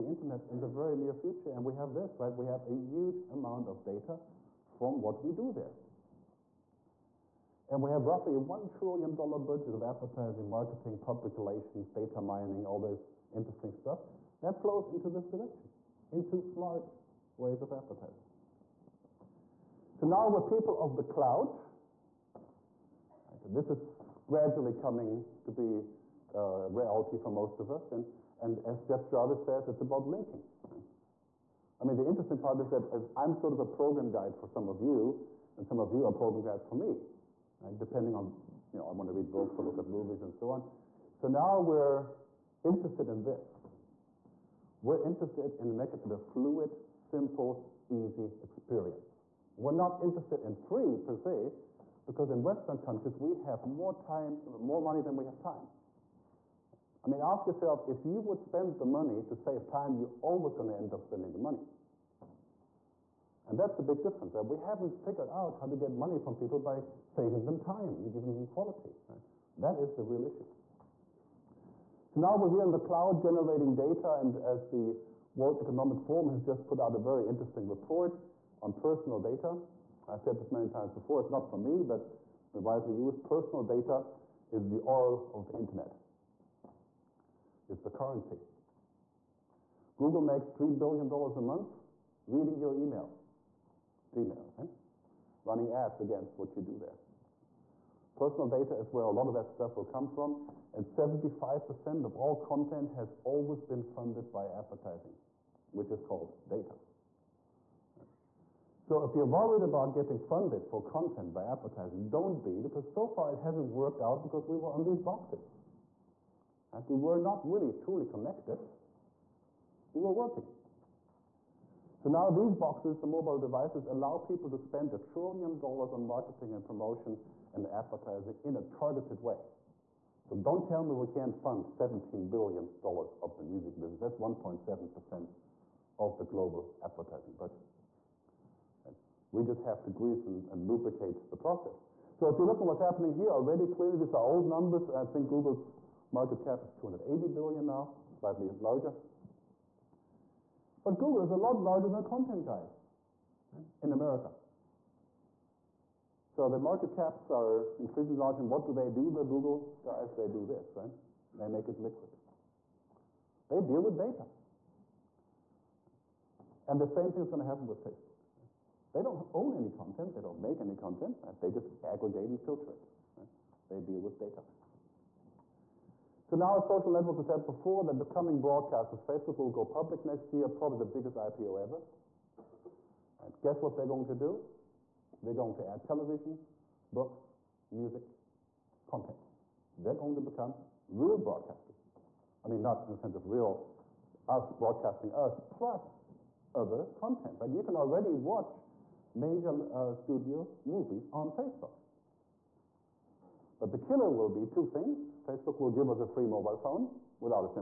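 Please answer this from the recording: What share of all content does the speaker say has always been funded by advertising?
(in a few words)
75%.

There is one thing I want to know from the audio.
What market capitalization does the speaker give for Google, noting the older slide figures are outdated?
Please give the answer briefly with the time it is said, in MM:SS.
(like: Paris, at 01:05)
280 billion, at 02:26.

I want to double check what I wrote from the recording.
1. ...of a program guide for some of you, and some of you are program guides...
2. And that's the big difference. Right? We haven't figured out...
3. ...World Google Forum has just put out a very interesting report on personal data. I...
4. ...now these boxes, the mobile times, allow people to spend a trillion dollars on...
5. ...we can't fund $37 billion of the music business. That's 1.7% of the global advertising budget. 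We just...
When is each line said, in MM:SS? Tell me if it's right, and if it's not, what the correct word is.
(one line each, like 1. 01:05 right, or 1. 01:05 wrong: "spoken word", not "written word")
1. 00:33 right
2. 01:03 right
3. 01:15 wrong: "Economic", not "Google"
4. 02:02 wrong: "devices", not "times"
5. 02:10 wrong: "17", not "37".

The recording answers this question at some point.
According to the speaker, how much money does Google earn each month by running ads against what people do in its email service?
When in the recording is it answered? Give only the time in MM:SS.
01:30.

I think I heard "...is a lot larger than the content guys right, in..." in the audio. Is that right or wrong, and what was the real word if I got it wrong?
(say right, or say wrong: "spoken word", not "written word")
right.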